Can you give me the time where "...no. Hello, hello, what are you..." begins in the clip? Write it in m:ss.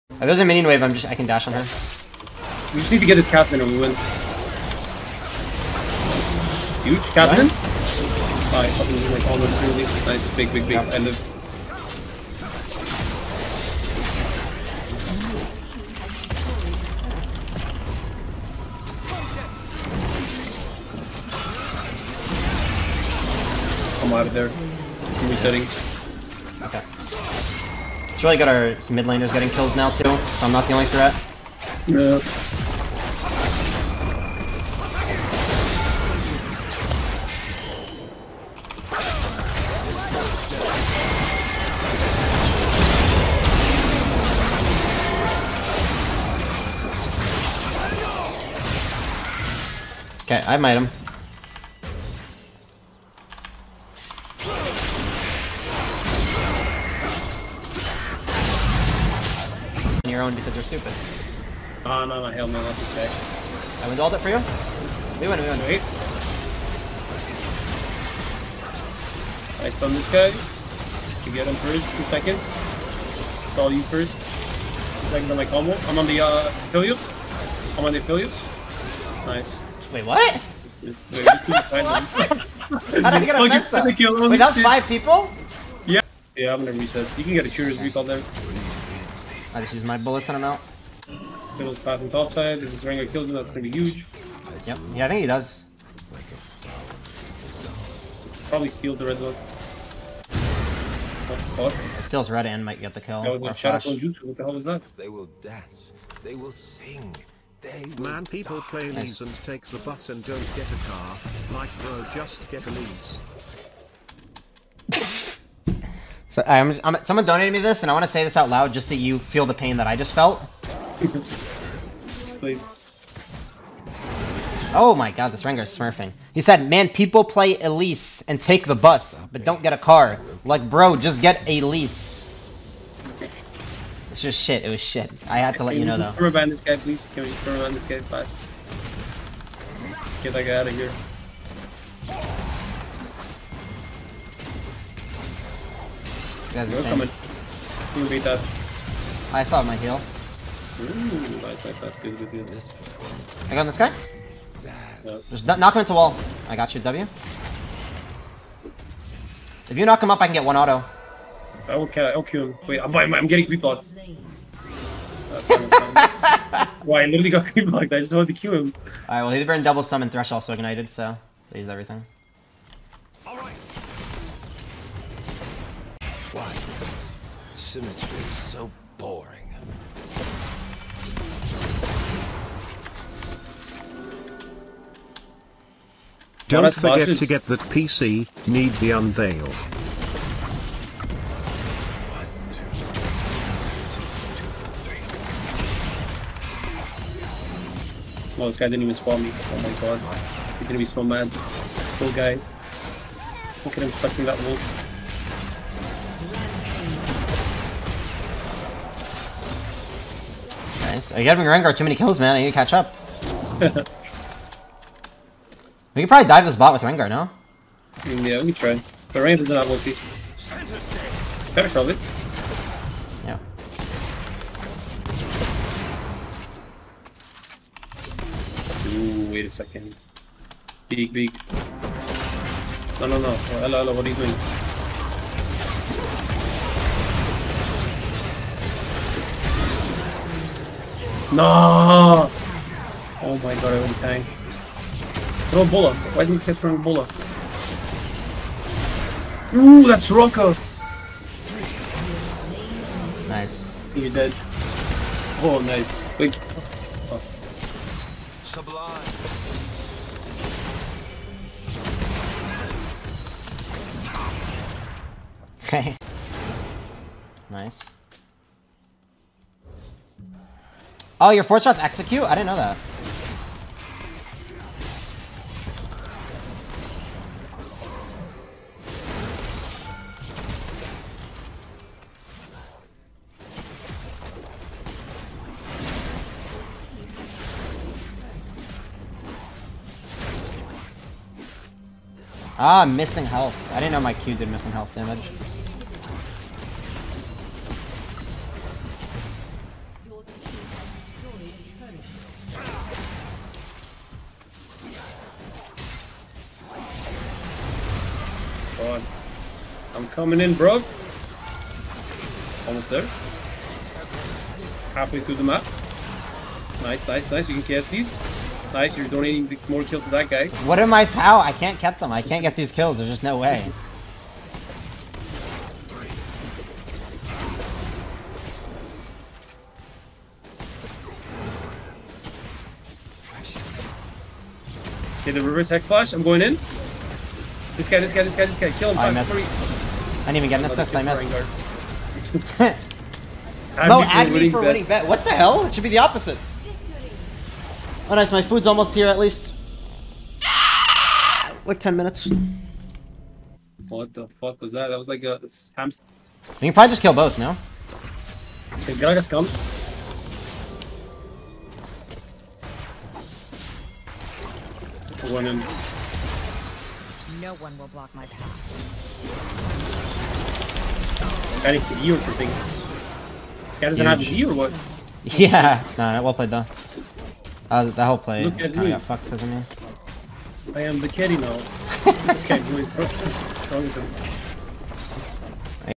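3:53.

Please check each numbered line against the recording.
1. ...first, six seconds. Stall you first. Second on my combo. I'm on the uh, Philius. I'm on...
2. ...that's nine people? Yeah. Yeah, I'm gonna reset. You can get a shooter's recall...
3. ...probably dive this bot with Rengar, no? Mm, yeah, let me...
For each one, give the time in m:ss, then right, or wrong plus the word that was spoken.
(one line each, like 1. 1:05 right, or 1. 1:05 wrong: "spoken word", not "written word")
1. 1:11 wrong: "two", not "six"
2. 1:24 wrong: "five", not "nine"
3. 3:36 right.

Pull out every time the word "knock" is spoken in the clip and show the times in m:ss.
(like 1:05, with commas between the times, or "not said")
2:35, 2:39.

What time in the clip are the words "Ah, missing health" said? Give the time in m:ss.
4:52.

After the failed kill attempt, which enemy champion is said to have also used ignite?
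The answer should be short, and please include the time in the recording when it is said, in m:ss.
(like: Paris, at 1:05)
Thresh, at 2:50.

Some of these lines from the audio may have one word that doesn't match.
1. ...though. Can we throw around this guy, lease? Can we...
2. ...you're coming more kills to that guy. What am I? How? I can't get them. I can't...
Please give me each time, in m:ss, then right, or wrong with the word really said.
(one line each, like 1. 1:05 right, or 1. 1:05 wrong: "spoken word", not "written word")
1. 2:15 wrong: "please", not "lease"
2. 5:18 wrong: "donating", not "coming".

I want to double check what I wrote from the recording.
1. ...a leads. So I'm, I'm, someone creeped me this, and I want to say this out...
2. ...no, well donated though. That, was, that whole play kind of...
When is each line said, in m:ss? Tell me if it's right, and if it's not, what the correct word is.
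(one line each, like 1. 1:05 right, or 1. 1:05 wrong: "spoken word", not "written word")
1. 1:52 wrong: "donated", not "creeped"
2. 6:15 wrong: "played", not "donated".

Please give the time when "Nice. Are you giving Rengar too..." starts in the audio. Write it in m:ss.
3:30.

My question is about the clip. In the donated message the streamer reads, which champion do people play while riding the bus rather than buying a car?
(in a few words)
Elise.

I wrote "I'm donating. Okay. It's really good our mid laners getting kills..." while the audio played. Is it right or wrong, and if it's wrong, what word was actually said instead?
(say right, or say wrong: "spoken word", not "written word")
wrong: "resetting", not "donating".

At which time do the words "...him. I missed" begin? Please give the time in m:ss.
5:38.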